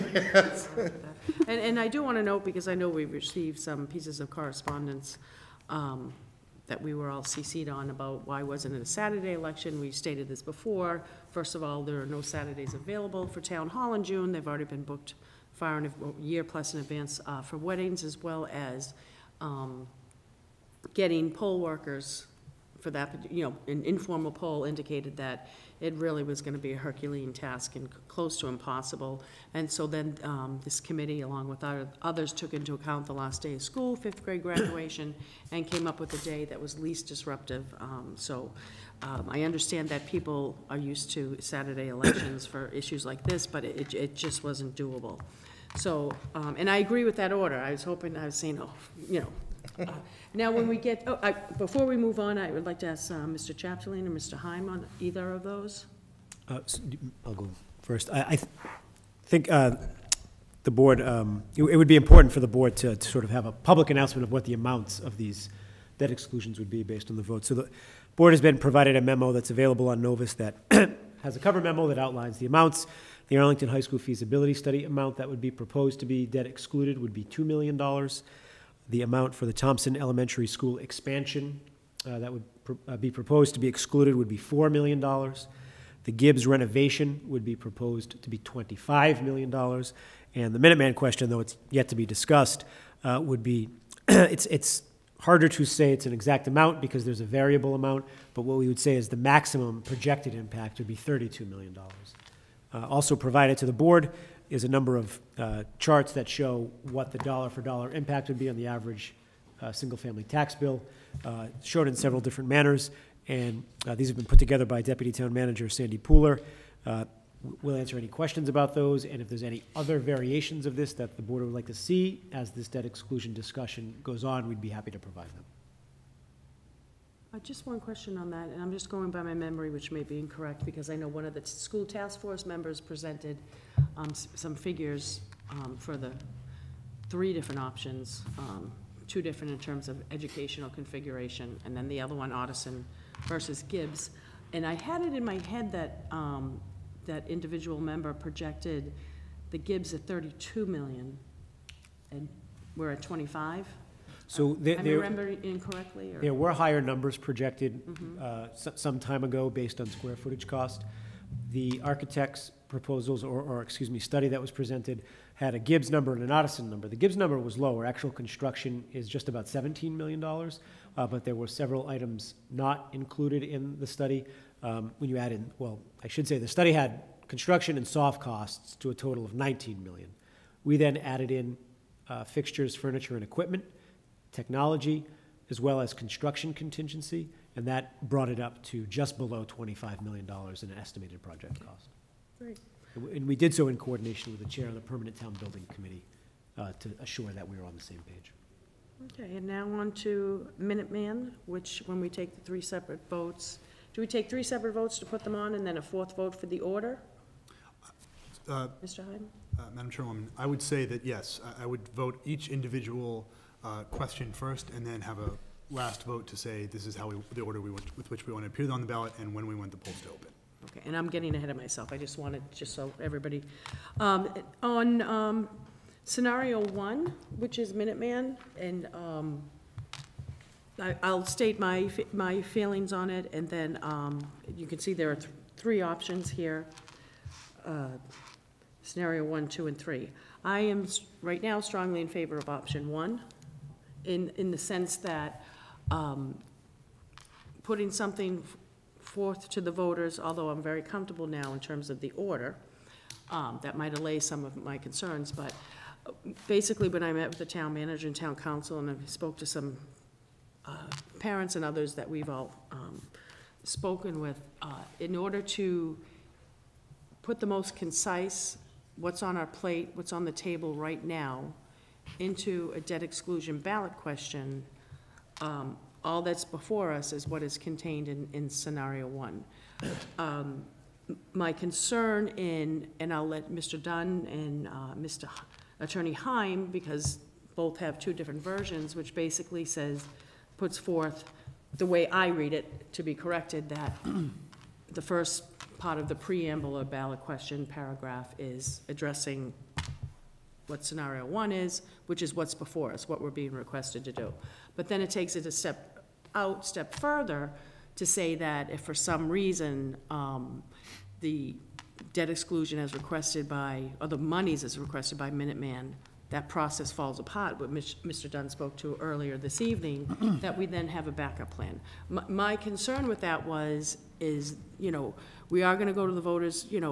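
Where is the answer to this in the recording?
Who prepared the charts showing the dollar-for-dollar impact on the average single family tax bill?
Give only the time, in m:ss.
1:55.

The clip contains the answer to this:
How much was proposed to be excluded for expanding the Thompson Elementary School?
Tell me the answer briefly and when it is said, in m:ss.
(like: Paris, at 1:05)
$4 million, at 1:24.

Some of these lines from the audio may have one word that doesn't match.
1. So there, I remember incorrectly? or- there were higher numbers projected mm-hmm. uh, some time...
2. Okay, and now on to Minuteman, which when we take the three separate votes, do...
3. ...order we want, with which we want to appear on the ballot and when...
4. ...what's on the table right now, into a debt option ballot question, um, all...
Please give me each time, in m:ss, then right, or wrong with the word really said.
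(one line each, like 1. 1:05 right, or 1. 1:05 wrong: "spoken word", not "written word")
1. 2:34 right
2. 3:19 right
3. 3:37 right
4. 4:29 wrong: "exclusion", not "option".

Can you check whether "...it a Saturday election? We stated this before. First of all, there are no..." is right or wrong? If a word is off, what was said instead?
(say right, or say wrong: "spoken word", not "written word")
right.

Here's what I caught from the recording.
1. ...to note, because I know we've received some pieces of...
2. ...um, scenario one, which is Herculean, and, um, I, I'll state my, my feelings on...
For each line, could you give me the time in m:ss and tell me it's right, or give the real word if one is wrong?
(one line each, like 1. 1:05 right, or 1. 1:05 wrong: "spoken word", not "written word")
1. 0:02 right
2. 3:45 wrong: "Minuteman", not "Herculean".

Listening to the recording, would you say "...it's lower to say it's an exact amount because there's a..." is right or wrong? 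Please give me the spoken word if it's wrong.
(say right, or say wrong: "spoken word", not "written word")
wrong: "harder", not "lower".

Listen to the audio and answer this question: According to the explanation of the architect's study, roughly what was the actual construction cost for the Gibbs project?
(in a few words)
$17 million.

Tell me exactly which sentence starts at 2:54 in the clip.
Um, When you add in, well, I should say, the study had construction and soft costs to a total of nineteen million.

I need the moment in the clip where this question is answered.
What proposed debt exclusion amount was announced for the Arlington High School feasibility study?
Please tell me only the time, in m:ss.
1:17.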